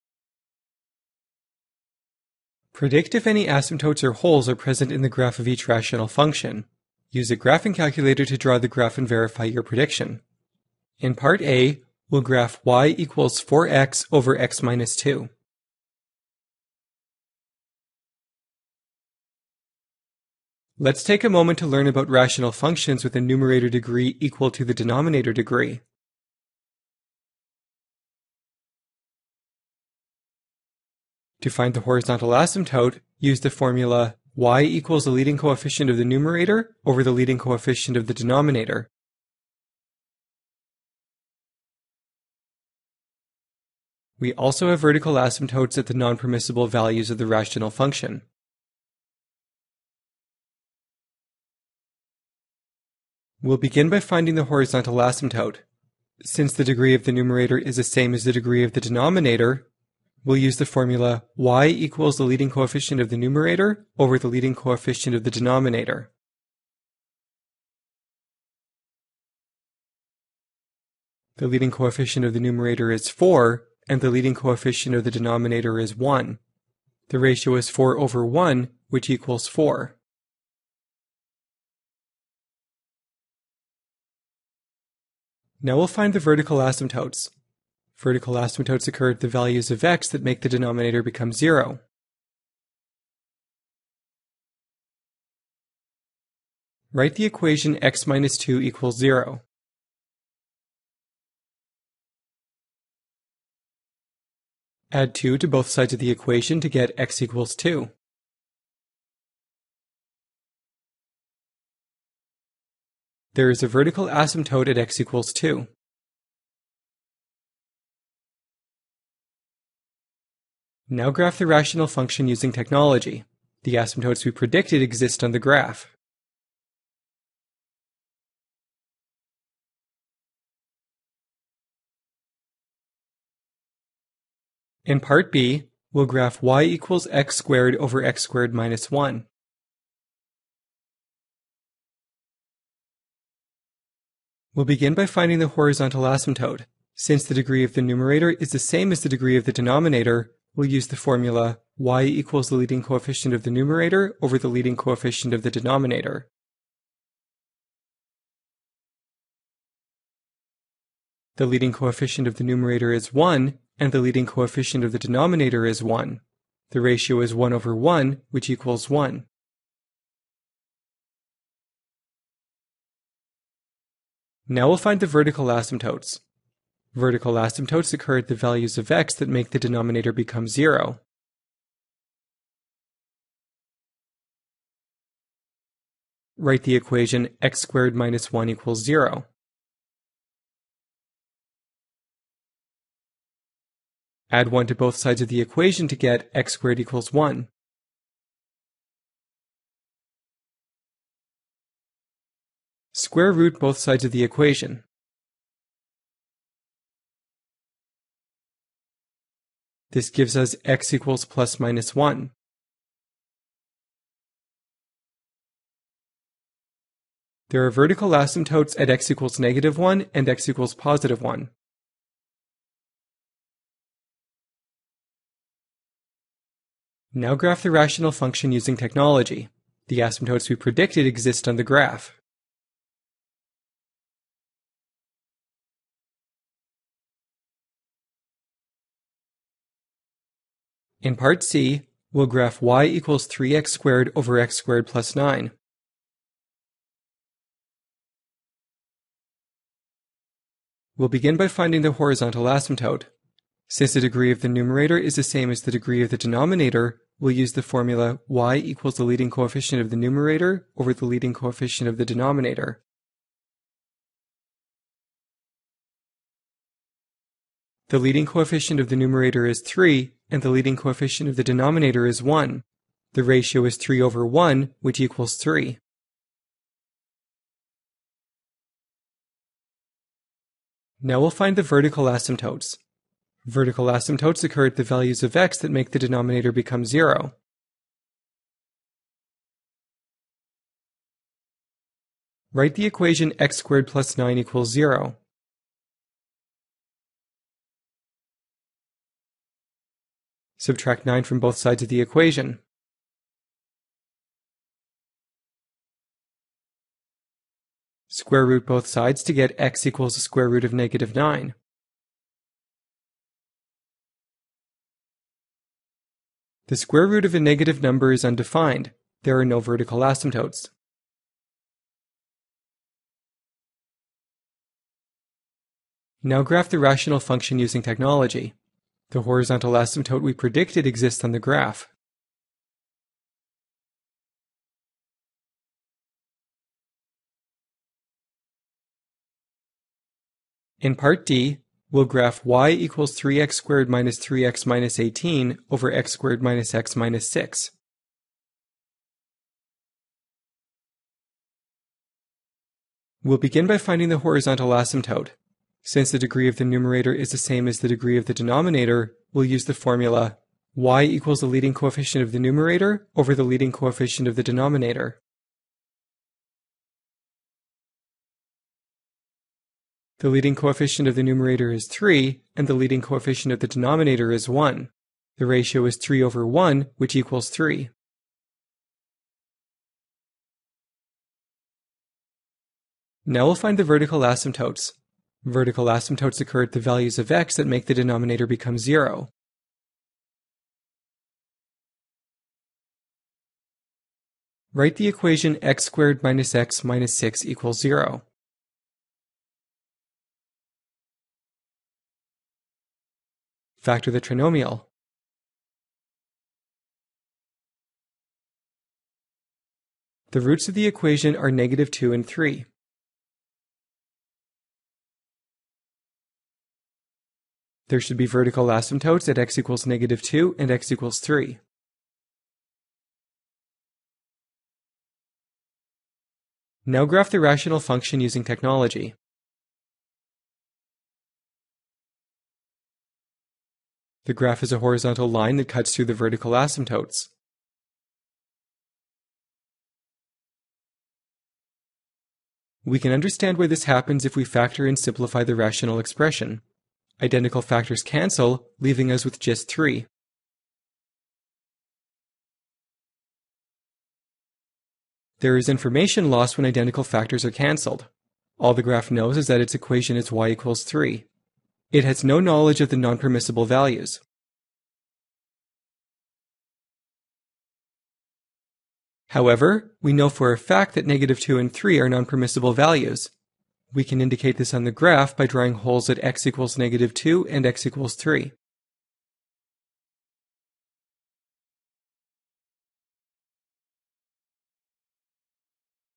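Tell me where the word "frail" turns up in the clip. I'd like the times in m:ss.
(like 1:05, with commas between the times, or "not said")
not said.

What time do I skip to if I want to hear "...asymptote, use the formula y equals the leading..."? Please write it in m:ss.
0:32.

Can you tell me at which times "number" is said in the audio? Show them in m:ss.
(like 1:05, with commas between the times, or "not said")
5:17.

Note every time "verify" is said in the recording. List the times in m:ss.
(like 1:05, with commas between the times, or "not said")
0:09.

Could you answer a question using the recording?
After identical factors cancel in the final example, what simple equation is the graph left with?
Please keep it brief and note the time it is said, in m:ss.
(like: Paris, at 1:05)
y = 3, at 7:40.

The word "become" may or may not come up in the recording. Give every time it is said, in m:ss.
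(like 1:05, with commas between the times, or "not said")
1:31, 3:00, 4:46, 6:28.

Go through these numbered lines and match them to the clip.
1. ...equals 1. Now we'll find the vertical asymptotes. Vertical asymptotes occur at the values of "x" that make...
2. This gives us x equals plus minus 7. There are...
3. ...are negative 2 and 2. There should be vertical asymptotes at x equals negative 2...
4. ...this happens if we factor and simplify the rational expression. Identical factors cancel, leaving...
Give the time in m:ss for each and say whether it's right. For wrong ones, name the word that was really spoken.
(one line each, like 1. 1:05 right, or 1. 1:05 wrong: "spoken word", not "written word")
1. 2:48 right
2. 3:29 wrong: "1", not "7"
3. 6:51 wrong: "3", not "2"
4. 7:23 right.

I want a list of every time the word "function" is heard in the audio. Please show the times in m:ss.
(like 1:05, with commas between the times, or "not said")
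0:06, 0:22, 0:47, 2:01, 3:48, 5:27, 7:07.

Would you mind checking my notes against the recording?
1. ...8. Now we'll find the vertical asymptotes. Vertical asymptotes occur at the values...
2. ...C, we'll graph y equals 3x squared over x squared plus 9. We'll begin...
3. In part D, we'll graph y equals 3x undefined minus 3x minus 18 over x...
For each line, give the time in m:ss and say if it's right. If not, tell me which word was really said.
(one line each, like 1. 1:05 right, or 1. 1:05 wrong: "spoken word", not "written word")
1. 1:19 wrong: "4", not "8"
2. 4:01 right
3. 5:40 wrong: "squared", not "undefined".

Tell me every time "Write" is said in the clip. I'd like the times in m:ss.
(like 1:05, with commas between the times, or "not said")
1:36, 3:06, 4:52, 6:34.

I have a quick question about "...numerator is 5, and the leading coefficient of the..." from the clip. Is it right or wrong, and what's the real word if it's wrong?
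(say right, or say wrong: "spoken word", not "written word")
wrong: "1", not "5".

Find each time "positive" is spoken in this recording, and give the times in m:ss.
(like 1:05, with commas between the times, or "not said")
3:40.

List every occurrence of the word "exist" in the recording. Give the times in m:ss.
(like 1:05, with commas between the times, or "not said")
2:04, 3:51, 5:30.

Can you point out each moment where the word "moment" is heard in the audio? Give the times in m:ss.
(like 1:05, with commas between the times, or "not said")
0:21.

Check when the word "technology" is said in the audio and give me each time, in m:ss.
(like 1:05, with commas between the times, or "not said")
2:02, 3:48, 5:27, 7:08.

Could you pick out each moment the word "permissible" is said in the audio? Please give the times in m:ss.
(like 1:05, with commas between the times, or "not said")
0:45, 7:42, 7:52.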